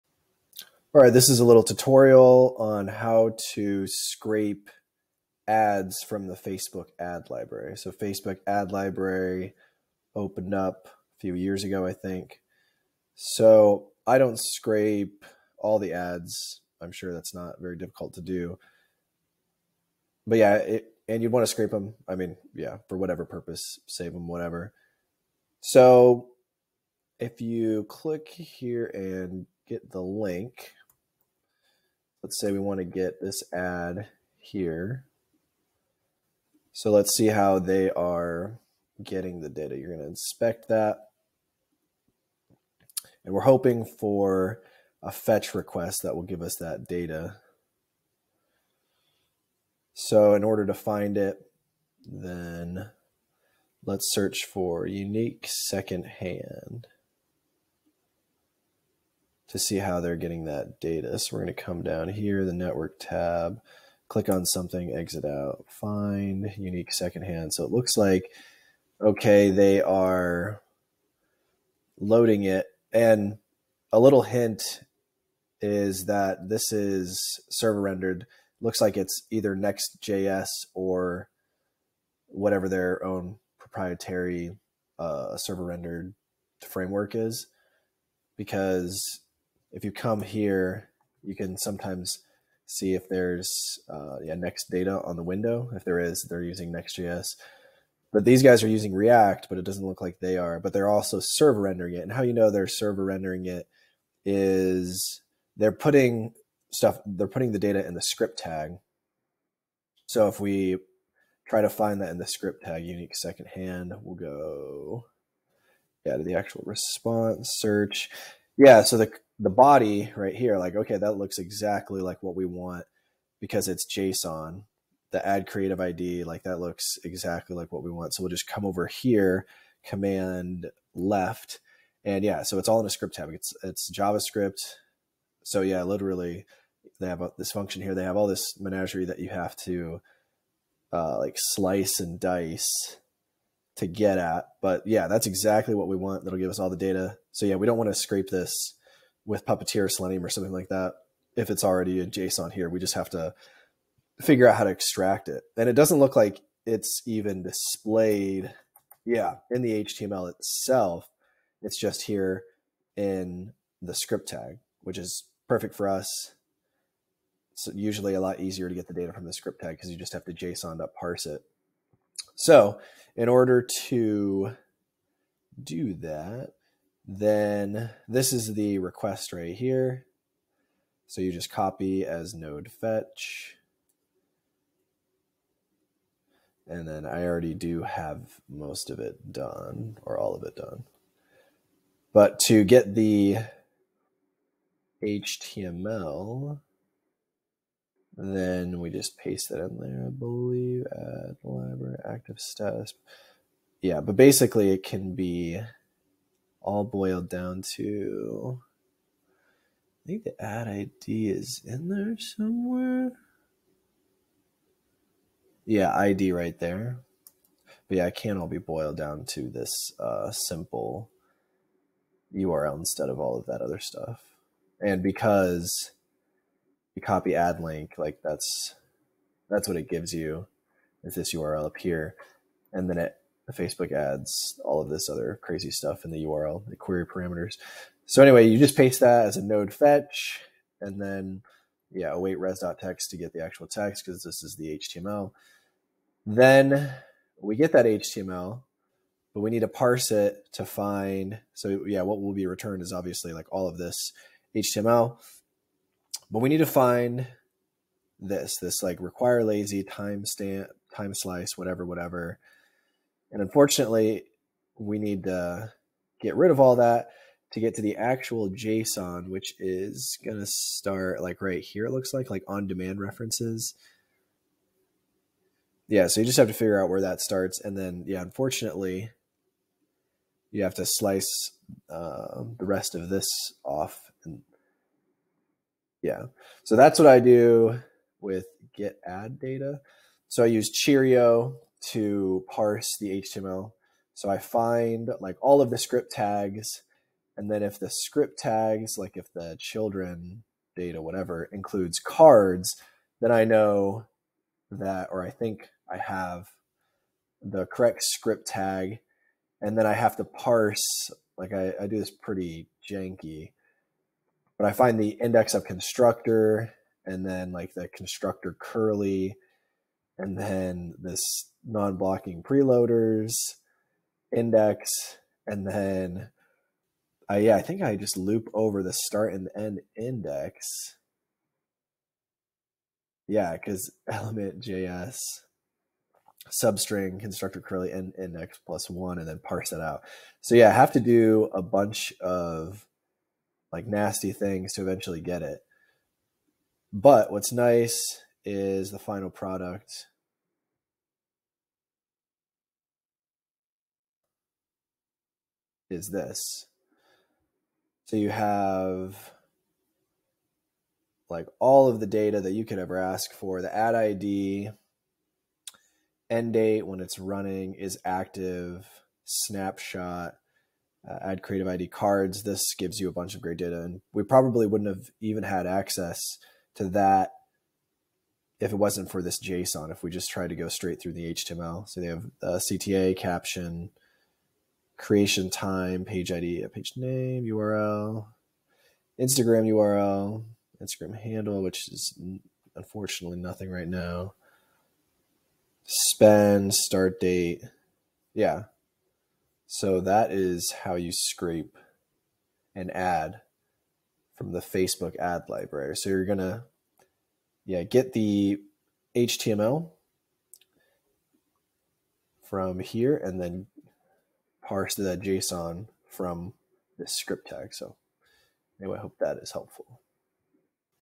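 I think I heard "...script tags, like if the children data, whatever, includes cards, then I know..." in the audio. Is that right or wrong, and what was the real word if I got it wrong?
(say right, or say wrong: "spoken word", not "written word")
right.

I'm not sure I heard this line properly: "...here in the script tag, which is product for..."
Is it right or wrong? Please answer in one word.
wrong.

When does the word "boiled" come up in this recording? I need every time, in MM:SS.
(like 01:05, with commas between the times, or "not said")
03:26, 03:38.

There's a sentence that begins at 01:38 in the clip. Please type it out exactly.
But these guys are using React, but it doesn't look like they are.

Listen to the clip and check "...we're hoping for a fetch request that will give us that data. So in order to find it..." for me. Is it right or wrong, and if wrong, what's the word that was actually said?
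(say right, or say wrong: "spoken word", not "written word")
right.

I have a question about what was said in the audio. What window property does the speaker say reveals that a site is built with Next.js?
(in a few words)
next data.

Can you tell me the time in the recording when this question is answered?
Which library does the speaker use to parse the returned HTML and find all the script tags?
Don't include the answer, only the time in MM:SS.
04:50.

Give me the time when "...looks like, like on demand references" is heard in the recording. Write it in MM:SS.
04:31.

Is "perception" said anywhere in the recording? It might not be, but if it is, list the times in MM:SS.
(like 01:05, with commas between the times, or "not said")
not said.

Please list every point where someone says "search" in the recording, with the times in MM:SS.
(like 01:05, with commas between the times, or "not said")
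00:54, 01:57.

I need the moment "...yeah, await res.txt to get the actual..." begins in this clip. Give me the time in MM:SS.
04:01.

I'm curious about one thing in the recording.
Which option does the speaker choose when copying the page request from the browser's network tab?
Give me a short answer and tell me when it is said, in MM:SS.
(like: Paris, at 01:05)
copy as node fetch, at 03:01.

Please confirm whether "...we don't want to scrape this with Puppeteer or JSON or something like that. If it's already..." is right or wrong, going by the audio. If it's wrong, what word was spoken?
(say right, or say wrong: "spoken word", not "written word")
wrong: "Selenium", not "JSON".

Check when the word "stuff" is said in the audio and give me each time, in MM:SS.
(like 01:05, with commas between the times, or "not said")
01:46, 03:43, 03:55.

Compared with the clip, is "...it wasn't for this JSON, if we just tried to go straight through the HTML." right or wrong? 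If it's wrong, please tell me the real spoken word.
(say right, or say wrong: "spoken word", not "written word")
right.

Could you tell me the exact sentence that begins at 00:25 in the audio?
So if you click here and get the link, let's say we want to get this ad here.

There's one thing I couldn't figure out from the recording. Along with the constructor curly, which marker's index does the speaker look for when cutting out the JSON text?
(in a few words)
non-blocking preloaders.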